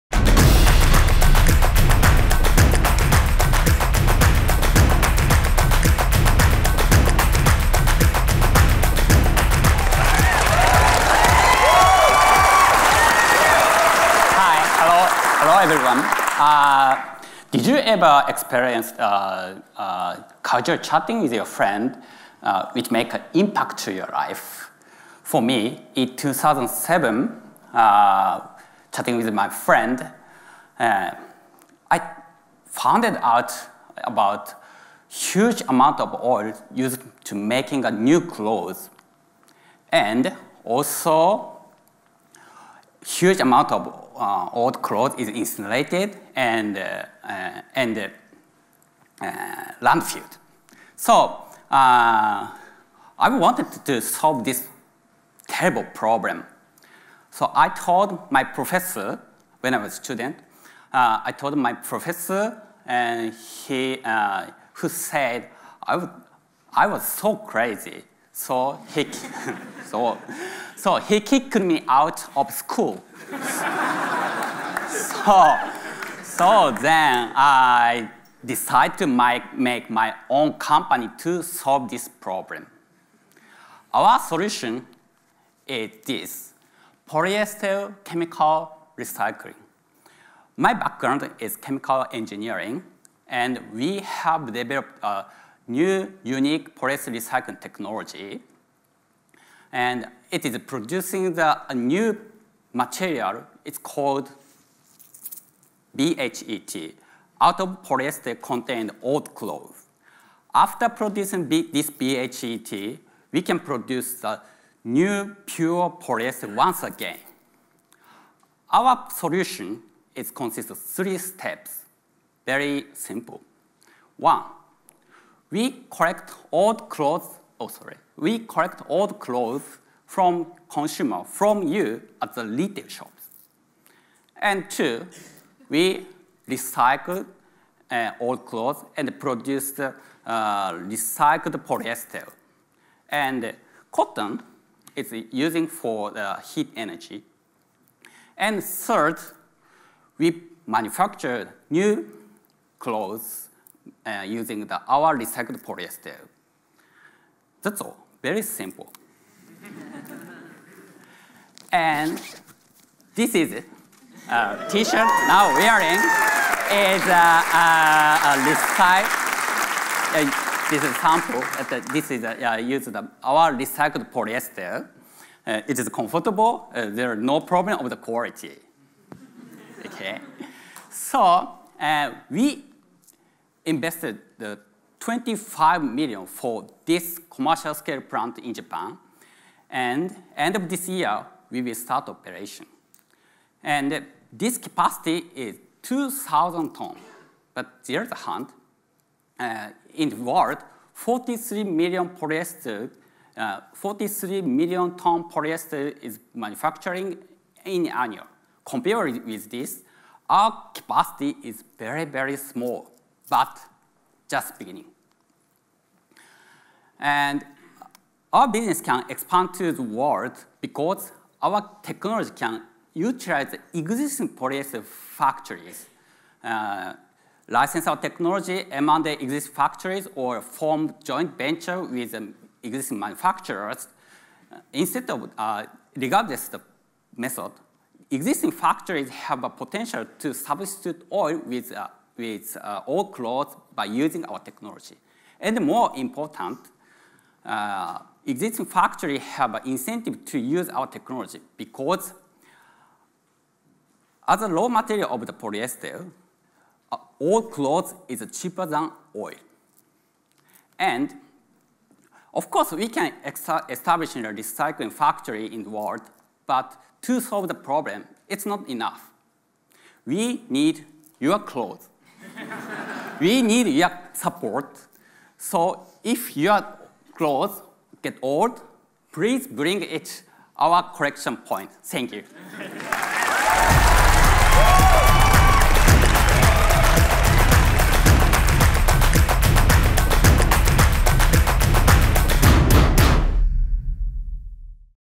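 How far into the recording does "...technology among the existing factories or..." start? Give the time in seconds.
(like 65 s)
227 s.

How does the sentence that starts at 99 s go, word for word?
And it is producing the, a new material.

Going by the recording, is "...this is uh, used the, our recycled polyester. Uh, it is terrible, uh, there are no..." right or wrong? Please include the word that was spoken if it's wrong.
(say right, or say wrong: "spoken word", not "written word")
wrong: "comfortable", not "terrible".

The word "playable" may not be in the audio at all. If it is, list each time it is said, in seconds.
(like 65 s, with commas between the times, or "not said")
not said.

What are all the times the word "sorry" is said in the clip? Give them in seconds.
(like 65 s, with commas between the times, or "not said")
127 s.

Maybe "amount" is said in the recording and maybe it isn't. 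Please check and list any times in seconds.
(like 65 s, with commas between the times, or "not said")
35 s, 43 s.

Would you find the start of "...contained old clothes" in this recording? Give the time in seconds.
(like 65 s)
108 s.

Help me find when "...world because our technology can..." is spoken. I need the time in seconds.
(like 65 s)
219 s.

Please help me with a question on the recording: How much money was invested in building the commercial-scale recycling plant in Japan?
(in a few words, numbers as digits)
25 million.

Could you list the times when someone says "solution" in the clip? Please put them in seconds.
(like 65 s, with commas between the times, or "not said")
84 s, 119 s.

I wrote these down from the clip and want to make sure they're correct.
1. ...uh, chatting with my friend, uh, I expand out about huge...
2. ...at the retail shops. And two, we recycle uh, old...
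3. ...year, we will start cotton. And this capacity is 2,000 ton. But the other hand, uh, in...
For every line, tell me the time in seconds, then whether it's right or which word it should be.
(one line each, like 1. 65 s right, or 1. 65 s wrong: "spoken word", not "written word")
1. 27 s wrong: "found", not "expand"
2. 132 s right
3. 190 s wrong: "operation", not "cotton".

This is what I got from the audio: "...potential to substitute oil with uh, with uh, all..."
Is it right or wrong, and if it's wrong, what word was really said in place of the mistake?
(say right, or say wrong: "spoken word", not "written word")
right.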